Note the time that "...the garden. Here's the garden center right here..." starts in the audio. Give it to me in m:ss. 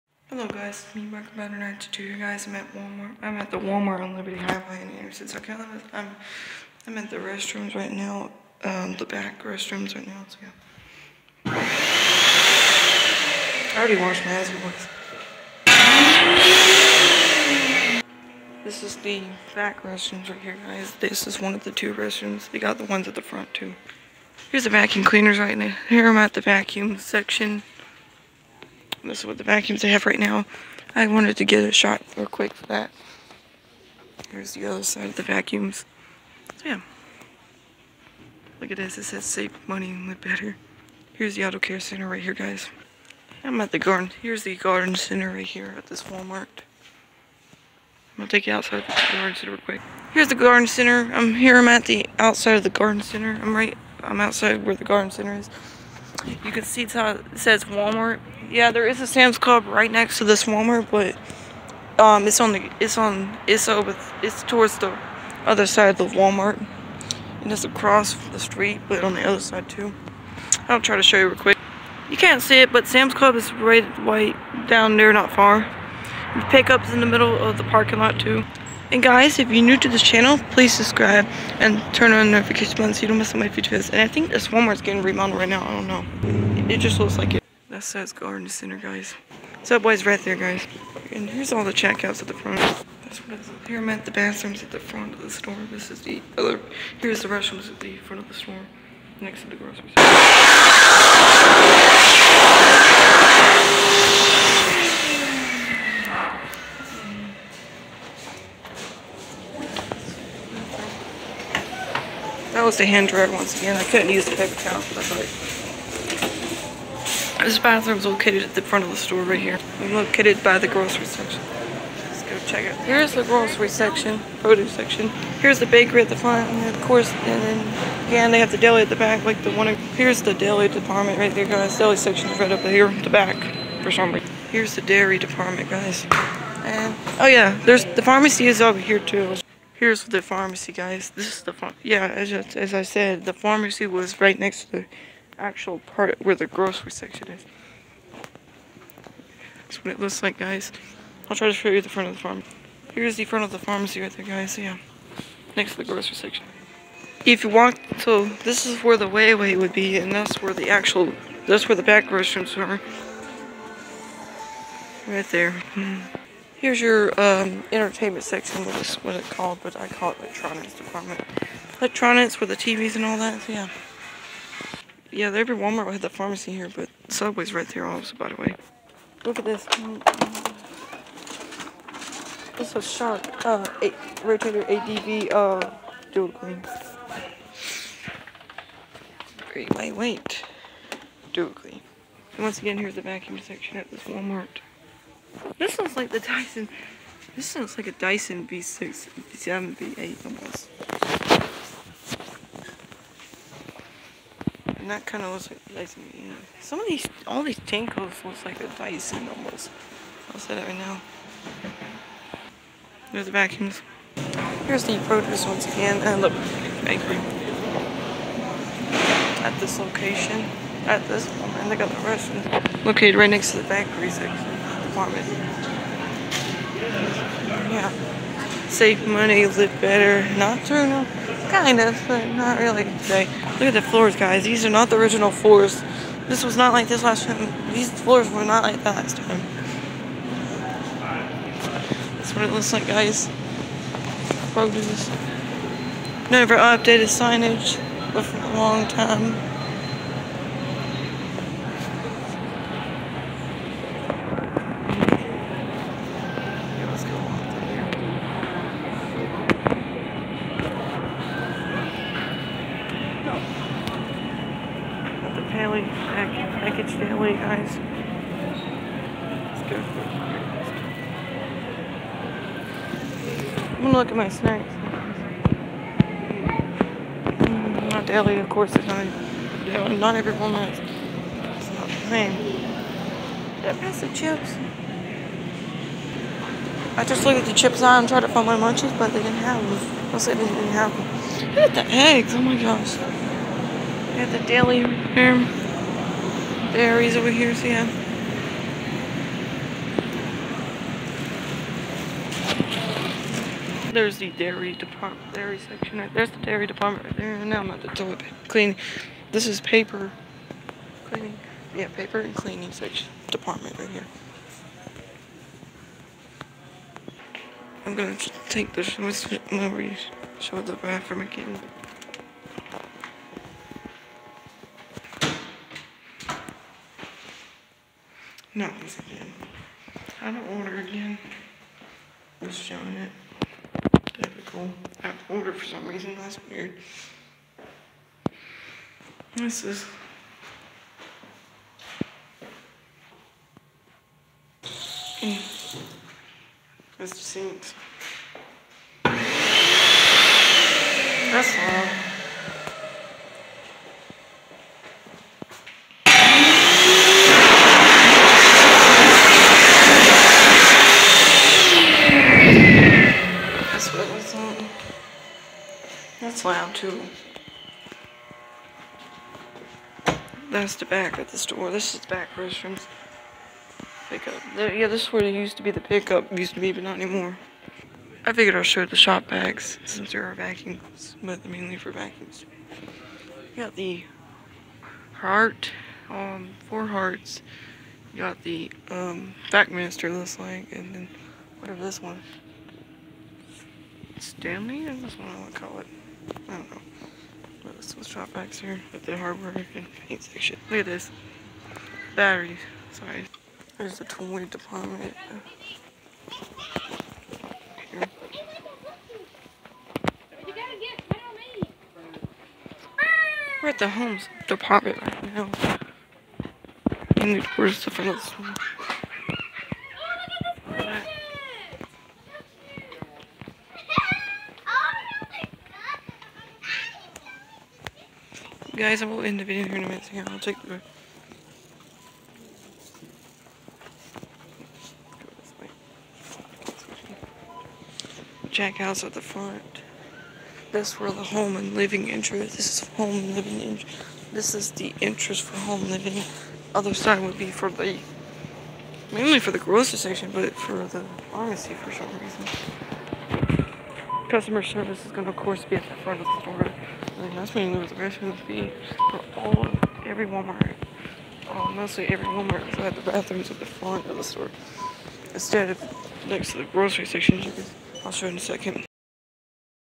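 0:43.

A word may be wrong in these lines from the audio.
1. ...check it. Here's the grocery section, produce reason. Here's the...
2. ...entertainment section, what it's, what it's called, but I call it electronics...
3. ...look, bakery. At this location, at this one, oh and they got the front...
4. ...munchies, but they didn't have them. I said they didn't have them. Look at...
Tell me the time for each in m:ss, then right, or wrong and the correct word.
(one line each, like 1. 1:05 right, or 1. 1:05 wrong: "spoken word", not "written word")
1. 2:02 wrong: "section", not "reason"
2. 2:47 right
3. 3:36 wrong: "restaurant", not "front"
4. 4:48 right.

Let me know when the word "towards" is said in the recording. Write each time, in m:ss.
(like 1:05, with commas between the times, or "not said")
1:04.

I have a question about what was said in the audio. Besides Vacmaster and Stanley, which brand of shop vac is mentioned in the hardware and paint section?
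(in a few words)
Hart.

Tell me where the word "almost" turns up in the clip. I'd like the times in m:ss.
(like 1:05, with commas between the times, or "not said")
3:20, 3:29.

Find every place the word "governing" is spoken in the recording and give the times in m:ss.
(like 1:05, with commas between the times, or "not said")
not said.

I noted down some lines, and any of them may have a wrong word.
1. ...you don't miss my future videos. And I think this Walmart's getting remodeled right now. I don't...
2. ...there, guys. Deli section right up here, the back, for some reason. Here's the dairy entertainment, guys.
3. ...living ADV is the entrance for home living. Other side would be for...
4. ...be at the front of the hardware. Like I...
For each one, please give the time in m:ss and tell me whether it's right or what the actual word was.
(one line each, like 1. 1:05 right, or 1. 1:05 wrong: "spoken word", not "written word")
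1. 1:23 right
2. 2:11 wrong: "department", not "entertainment"
3. 7:23 wrong: "This", not "ADV"
4. 7:35 wrong: "store", not "hardware".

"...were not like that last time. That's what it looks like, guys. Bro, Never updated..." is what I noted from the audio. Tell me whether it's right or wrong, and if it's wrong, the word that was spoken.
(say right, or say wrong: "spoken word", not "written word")
right.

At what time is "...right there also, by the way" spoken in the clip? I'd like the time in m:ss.
2:57.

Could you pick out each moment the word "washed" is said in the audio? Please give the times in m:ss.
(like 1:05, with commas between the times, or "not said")
0:13.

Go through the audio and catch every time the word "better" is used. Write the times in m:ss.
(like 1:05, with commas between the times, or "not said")
0:40, 3:49.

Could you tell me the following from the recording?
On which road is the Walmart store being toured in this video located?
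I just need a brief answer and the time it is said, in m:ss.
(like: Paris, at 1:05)
Liberty Highway, at 0:04.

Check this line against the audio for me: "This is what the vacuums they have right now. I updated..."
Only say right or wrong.
wrong.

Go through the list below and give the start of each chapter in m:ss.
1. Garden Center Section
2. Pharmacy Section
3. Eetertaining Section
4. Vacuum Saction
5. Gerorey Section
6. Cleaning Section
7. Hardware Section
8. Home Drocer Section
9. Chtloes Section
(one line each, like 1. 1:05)
1. 0:10
2. 2:00
3. 2:30
4. 3:00
5. 3:35
6. 5:05
7. 6:05
8. 6:45
9. 7:15.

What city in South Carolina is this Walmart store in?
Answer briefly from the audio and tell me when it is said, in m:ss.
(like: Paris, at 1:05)
Anderson, at 0:04.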